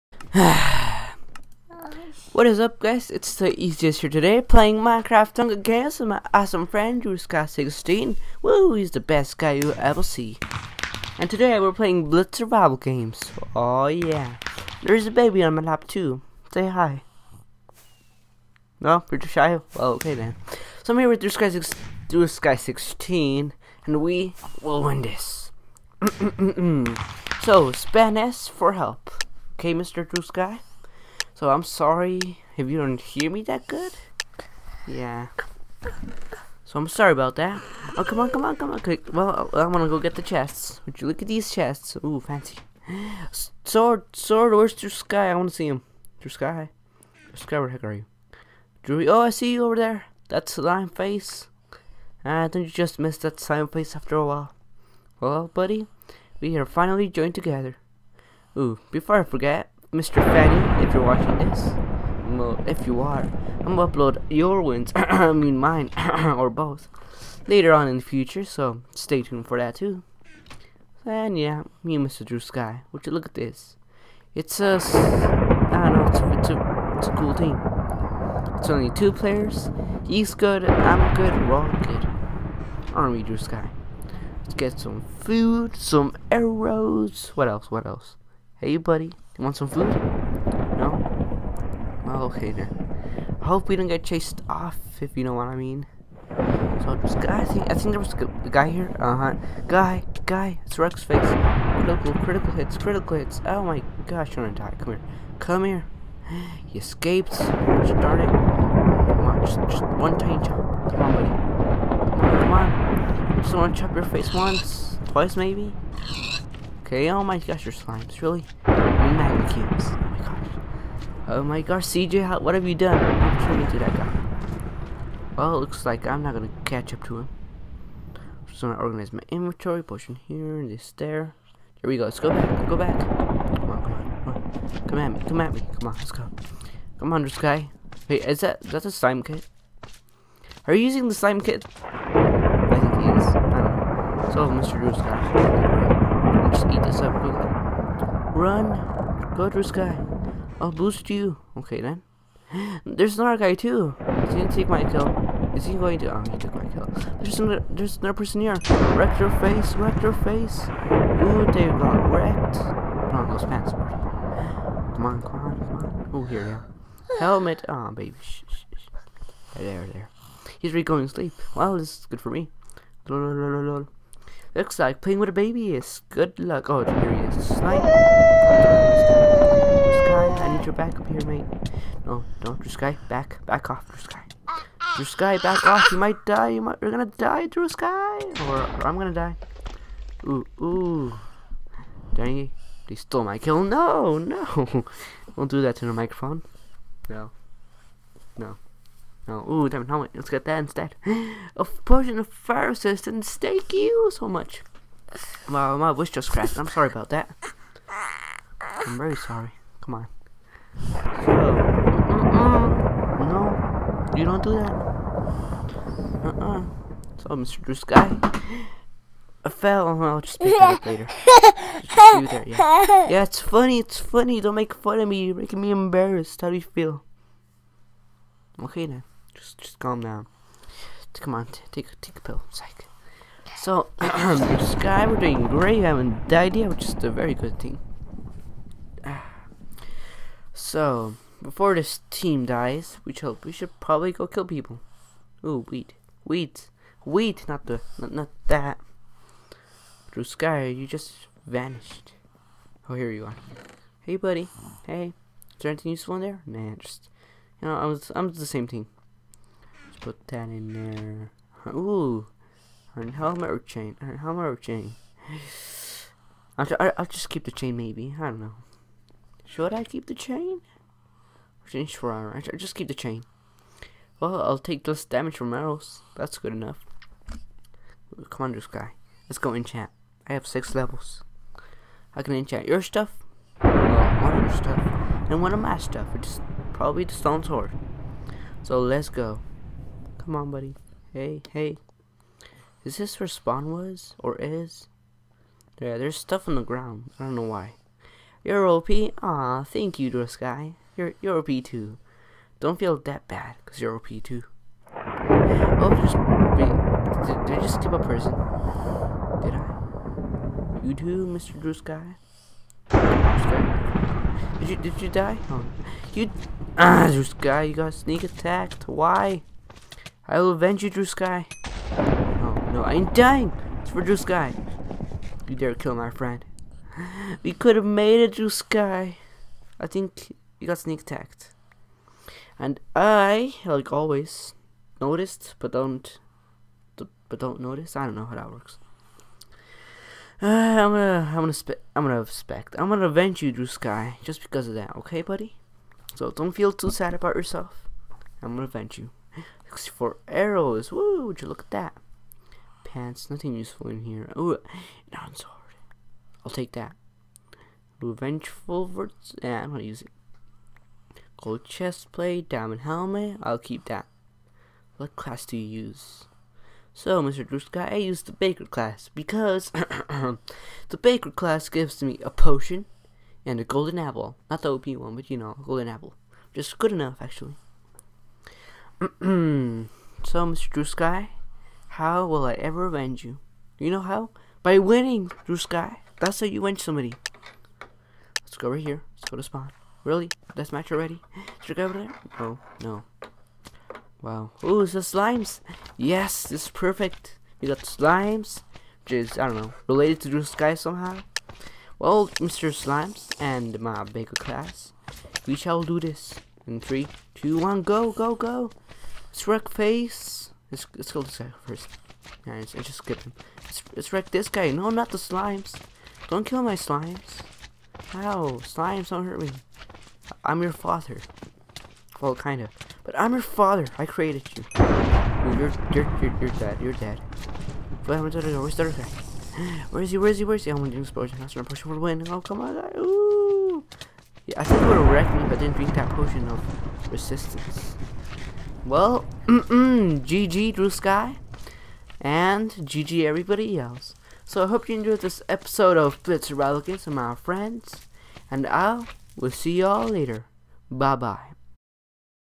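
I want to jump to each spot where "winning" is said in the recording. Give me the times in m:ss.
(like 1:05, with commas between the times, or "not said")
6:24.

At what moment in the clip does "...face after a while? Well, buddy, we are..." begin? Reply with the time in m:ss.
0:53.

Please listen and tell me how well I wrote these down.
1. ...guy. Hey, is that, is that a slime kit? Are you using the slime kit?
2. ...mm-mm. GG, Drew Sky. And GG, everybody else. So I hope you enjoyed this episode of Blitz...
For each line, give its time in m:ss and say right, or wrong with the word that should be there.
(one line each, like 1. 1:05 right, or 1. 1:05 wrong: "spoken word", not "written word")
1. 2:17 right
2. 7:19 right.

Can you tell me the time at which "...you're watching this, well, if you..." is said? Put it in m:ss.
1:00.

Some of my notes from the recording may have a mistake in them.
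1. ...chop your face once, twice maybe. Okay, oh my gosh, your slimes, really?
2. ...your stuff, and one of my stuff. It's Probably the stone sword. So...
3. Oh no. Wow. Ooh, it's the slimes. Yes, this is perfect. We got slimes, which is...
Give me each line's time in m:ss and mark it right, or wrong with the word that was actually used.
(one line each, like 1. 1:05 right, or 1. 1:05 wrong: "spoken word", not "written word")
1. 1:53 right
2. 4:44 right
3. 6:32 right.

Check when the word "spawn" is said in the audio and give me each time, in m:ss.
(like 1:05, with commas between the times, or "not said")
4:53, 6:29.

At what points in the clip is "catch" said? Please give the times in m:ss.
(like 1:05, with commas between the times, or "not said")
2:06.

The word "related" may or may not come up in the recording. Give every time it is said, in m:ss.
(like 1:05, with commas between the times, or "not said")
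6:39.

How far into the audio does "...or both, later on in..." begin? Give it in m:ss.
1:06.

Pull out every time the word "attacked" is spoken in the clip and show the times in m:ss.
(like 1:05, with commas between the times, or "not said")
5:18, 5:31.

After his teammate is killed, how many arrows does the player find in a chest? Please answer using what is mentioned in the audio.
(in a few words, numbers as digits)
64.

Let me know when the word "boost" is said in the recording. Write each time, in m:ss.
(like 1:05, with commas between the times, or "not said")
2:30.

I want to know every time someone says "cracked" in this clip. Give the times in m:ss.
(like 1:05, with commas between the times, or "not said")
3:26.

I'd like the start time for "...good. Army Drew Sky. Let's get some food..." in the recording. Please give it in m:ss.
1:21.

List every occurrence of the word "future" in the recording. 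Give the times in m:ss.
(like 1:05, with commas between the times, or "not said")
1:08.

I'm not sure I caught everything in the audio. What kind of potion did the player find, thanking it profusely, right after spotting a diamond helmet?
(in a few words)
fire resistance.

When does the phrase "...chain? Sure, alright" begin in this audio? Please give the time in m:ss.
4:30.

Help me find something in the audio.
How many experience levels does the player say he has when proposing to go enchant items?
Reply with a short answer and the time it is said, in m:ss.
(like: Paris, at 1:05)
6, at 4:40.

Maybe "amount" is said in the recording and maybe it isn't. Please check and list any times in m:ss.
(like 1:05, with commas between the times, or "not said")
not said.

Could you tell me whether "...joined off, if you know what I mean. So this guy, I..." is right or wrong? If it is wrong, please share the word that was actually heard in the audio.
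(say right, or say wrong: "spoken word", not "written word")
wrong: "chased", not "joined".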